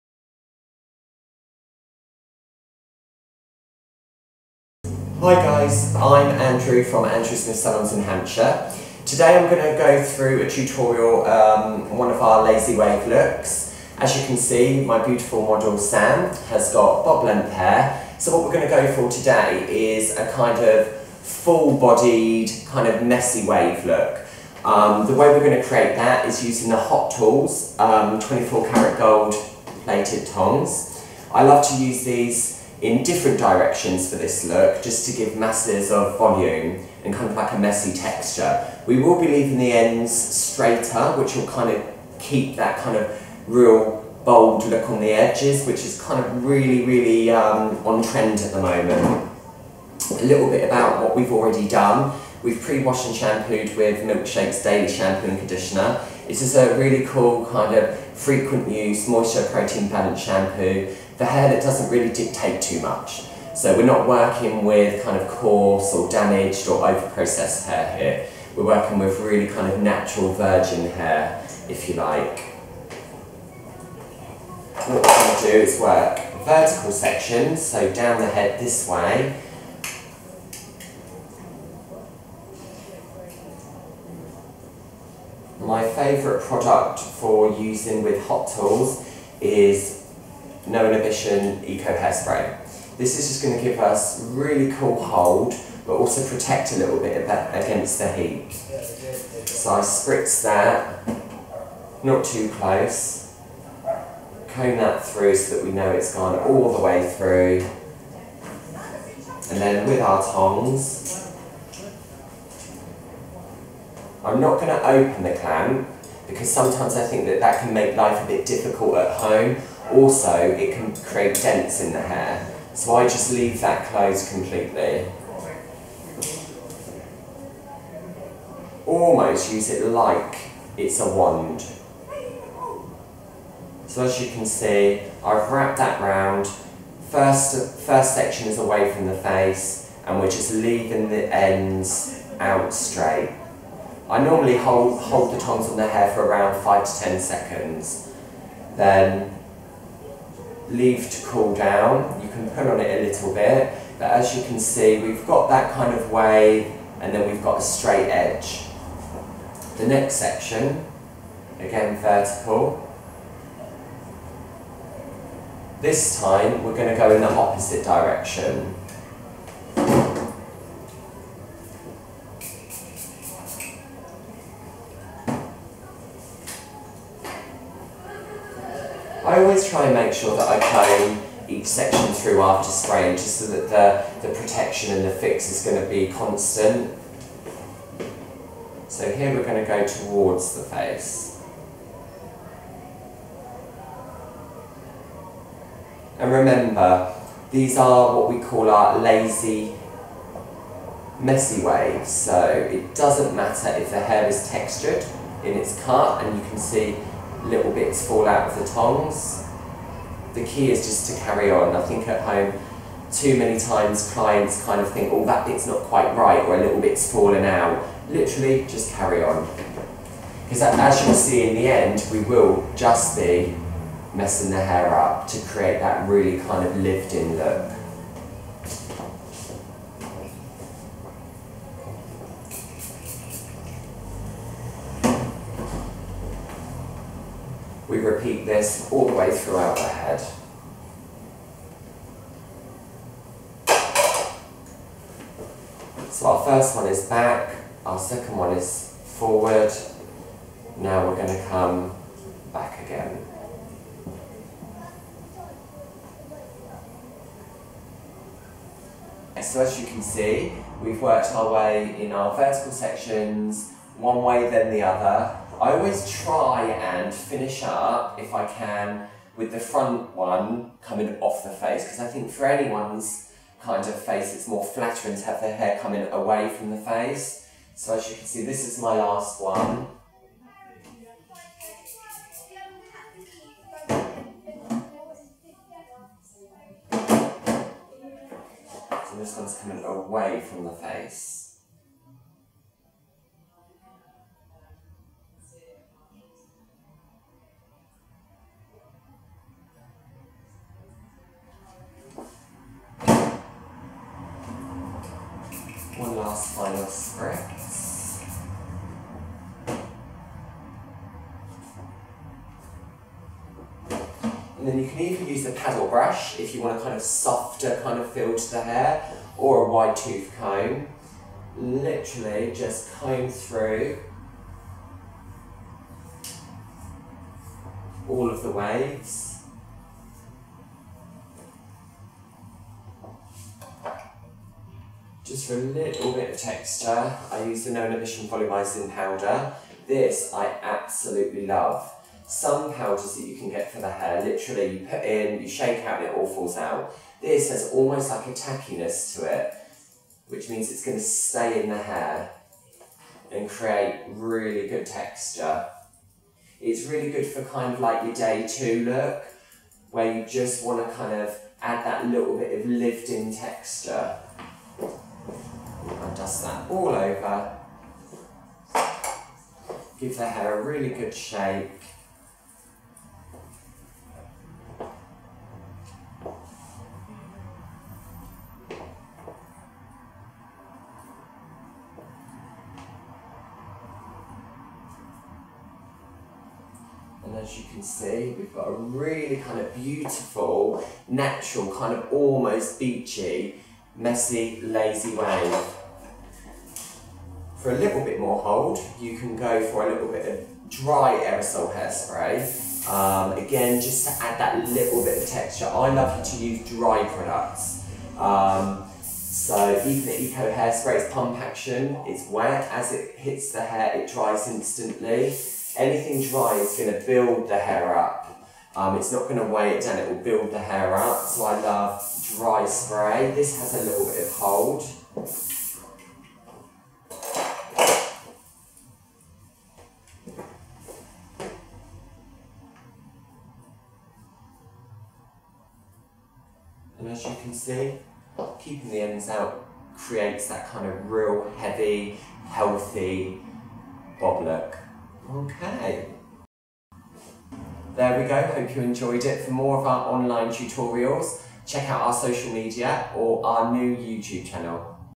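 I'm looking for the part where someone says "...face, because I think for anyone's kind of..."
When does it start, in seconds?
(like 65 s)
271 s.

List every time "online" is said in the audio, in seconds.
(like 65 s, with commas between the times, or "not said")
450 s.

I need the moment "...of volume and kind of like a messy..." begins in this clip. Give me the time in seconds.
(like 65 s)
35 s.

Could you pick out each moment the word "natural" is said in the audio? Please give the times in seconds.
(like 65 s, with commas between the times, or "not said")
69 s, 391 s.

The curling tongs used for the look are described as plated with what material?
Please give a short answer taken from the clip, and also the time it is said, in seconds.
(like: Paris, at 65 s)
24 karat gold, at 28 s.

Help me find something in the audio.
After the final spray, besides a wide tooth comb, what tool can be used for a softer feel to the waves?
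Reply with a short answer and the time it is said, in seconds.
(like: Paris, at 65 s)
paddle brush, at 315 s.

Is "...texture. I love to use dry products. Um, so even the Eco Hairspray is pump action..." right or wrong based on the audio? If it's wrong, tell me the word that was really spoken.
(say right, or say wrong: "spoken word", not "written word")
right.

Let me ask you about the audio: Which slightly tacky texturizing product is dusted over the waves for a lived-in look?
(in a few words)
Volumizing Powder.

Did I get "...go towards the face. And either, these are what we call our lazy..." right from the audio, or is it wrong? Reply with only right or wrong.
wrong.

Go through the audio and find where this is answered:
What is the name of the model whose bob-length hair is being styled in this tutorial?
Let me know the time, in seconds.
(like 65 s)
15 s.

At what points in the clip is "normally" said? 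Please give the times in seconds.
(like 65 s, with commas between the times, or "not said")
144 s.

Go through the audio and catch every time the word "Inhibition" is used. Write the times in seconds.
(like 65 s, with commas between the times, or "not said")
90 s, 337 s.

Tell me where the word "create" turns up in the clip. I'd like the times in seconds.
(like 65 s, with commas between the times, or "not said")
25 s, 120 s, 225 s, 353 s, 439 s.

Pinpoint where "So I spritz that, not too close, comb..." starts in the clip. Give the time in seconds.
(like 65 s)
98 s.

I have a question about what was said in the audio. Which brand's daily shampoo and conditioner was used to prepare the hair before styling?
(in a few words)
Milkshake.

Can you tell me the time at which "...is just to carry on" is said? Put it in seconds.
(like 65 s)
210 s.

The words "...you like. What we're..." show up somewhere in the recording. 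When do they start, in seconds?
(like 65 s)
71 s.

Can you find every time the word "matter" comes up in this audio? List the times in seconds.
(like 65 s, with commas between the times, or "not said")
203 s.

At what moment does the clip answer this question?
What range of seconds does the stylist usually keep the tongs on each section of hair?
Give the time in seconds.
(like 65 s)
146 s.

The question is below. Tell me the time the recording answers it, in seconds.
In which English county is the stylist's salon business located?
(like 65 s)
8 s.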